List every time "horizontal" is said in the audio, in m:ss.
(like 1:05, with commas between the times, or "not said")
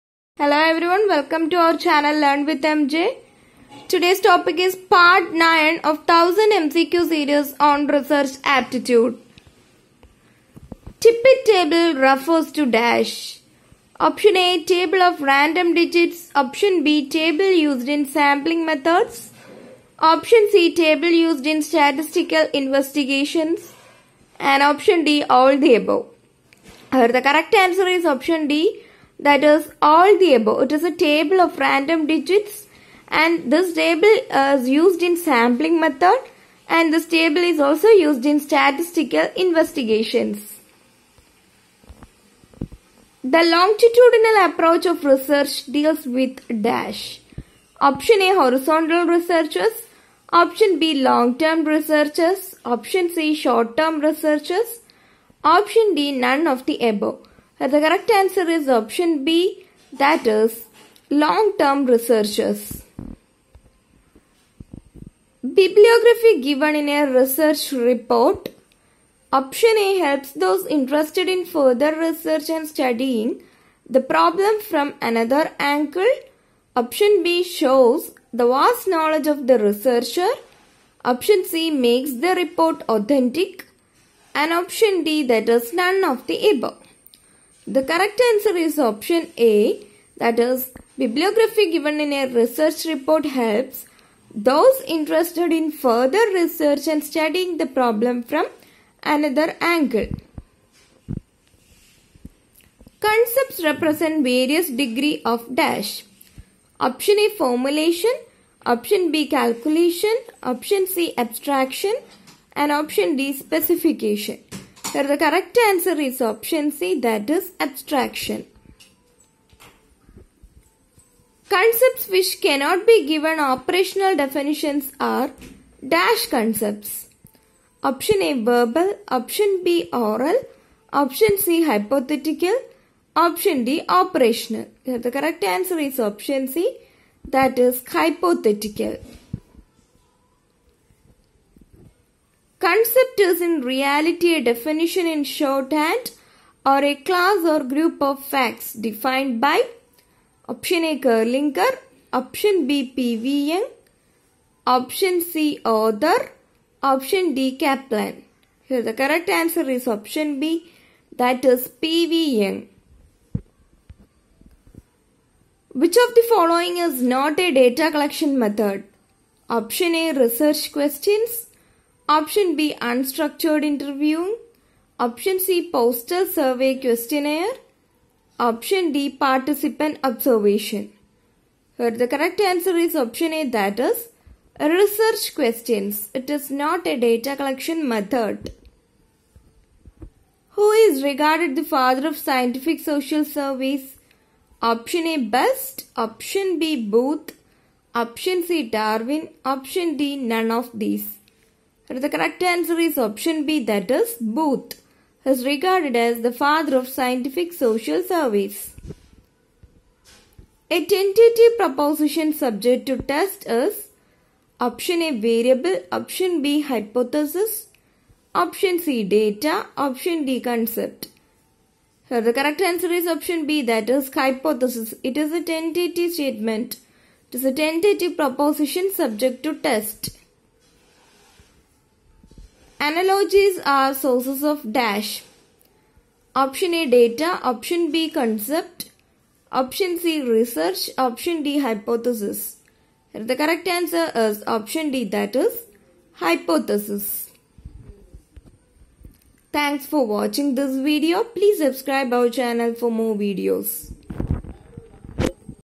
0:48.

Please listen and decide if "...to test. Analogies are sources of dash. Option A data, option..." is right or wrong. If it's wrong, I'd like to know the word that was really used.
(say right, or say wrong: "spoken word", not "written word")
right.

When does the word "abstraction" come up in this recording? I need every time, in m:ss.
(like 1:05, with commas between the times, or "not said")
1:51, 1:57.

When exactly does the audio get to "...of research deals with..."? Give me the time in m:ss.
0:44.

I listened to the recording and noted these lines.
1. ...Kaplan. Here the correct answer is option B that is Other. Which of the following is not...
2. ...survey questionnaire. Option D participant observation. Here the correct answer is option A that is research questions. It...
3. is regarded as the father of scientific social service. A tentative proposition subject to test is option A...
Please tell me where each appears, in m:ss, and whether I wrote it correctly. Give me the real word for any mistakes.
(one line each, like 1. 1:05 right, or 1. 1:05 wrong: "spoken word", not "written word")
1. 2:37 wrong: "PVN", not "Other"
2. 2:56 right
3. 3:25 right.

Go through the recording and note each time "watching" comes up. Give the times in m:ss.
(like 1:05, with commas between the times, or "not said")
4:10.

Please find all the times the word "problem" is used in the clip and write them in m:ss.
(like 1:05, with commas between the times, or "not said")
1:14, 1:37.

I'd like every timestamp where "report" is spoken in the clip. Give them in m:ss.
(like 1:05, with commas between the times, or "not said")
1:07, 1:22, 1:32.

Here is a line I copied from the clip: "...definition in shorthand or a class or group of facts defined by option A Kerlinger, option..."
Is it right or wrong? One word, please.
right.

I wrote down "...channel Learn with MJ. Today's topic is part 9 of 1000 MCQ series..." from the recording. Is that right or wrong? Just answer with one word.
right.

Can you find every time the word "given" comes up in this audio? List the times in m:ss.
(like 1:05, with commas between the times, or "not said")
1:06, 1:31, 2:03.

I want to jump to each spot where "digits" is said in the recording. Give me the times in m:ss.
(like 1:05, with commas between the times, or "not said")
0:15, 0:32.